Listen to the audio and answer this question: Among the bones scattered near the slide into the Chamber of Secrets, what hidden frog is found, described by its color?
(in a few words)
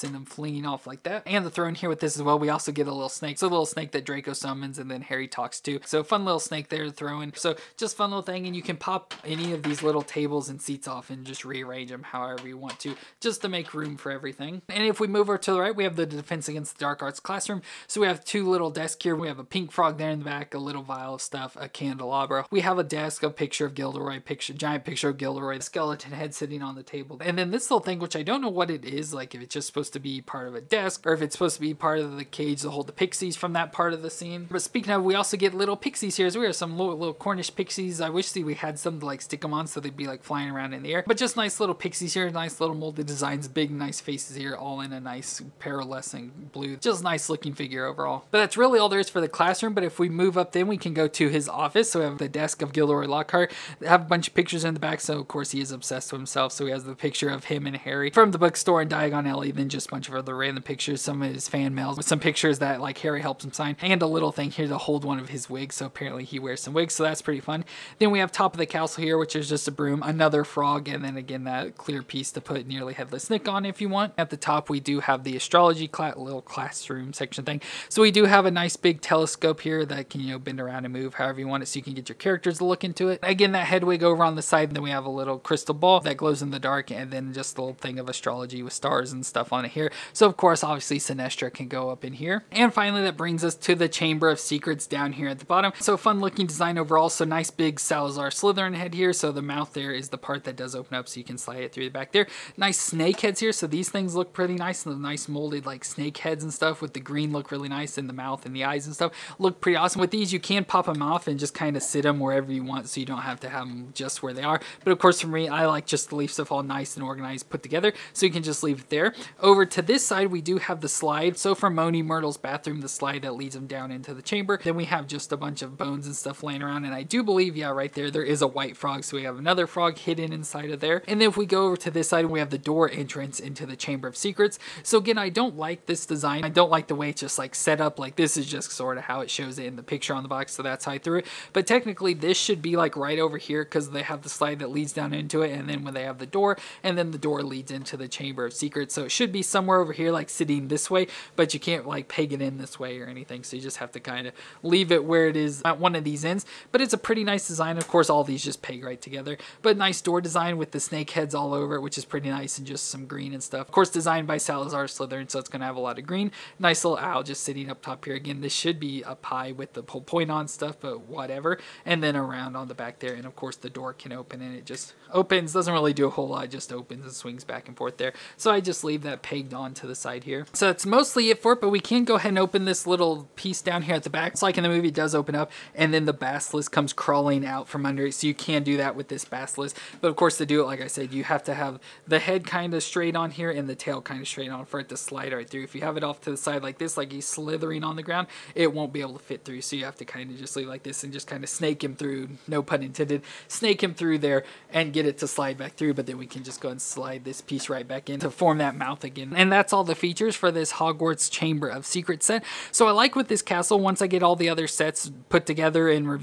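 white frog.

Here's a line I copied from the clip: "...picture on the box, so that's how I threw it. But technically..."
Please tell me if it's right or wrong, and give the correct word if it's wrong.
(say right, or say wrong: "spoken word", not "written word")
right.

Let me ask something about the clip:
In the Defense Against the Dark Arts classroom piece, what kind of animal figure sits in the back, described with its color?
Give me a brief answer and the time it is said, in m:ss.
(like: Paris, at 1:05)
pink frog, at 0:19.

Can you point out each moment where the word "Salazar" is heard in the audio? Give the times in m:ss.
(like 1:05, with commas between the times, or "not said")
1:37, 2:44.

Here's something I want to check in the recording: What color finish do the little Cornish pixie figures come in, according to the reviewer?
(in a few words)
pearlescent blue.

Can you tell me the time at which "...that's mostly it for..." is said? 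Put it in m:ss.
3:00.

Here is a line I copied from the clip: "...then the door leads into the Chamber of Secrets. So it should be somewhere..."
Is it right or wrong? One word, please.
right.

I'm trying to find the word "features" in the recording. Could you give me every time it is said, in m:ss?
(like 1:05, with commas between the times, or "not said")
3:29.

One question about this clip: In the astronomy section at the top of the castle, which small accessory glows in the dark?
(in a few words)
crystal ball.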